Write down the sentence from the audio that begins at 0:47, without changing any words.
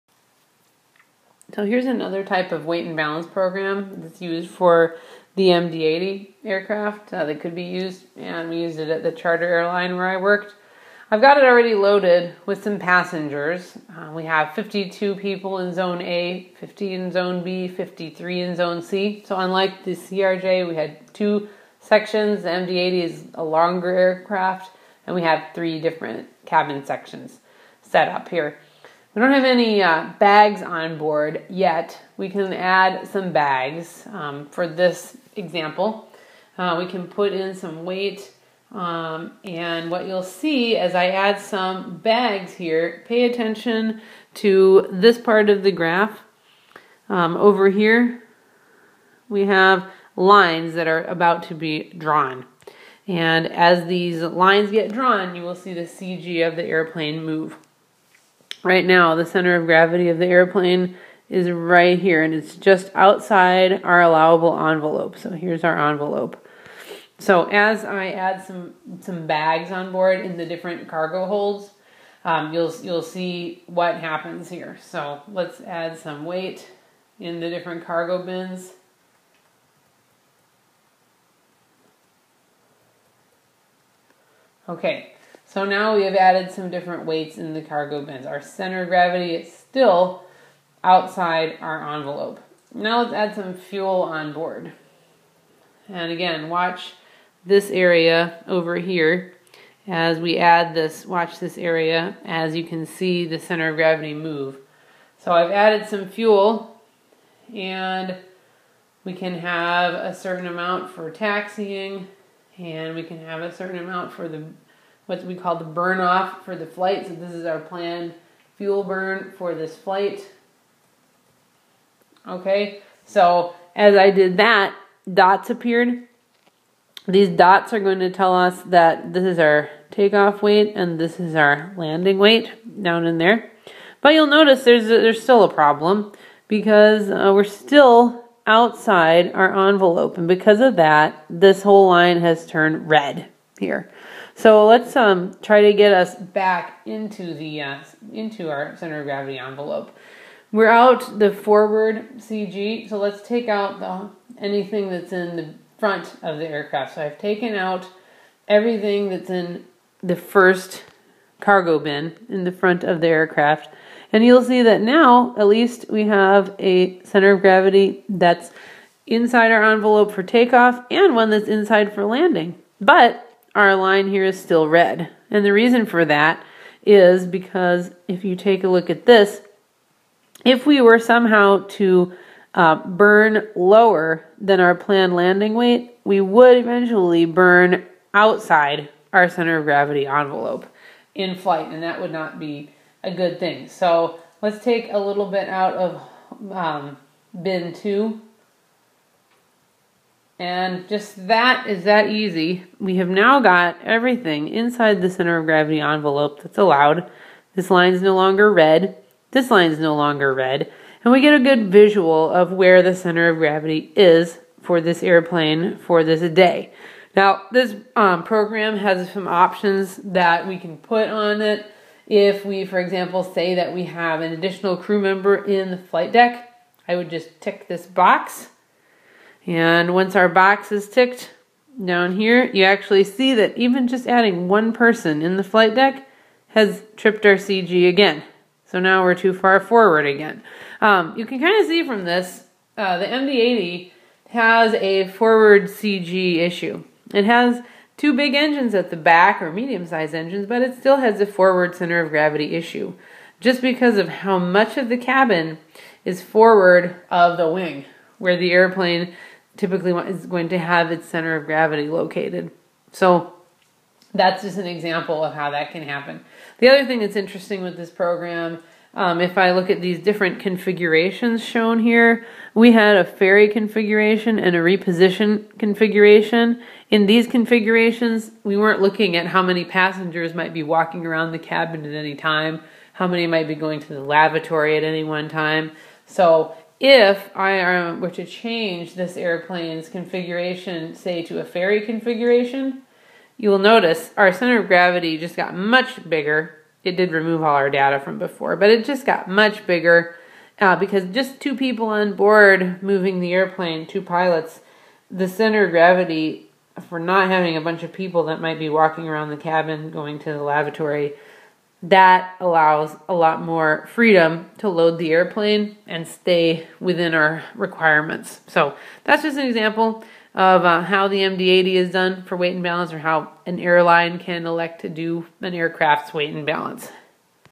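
Um, over here, we have lines that are about to be drawn.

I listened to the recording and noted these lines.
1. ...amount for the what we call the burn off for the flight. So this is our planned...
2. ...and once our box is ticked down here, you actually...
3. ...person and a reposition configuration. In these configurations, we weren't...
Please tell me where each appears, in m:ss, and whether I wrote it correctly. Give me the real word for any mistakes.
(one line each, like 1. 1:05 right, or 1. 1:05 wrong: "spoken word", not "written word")
1. 1:53 right
2. 3:49 right
3. 4:33 wrong: "configuration", not "person".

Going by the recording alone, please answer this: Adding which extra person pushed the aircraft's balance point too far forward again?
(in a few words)
Additional crew member.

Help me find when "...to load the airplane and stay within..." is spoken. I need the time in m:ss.
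5:14.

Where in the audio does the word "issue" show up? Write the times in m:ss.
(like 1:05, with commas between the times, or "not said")
4:06, 4:12.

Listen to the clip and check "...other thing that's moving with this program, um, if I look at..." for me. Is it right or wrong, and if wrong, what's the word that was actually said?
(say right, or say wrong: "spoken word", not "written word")
wrong: "interesting", not "moving".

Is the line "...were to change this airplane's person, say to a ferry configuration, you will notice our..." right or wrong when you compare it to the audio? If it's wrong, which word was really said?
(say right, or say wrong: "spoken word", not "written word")
wrong: "configuration", not "person".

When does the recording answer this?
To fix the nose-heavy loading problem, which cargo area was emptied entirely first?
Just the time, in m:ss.
2:40.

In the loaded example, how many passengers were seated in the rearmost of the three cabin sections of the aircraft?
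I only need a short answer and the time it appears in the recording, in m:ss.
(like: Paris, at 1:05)
53, at 0:17.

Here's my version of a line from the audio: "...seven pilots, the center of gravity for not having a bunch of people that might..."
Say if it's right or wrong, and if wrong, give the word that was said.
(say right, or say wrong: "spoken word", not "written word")
wrong: "two", not "seven".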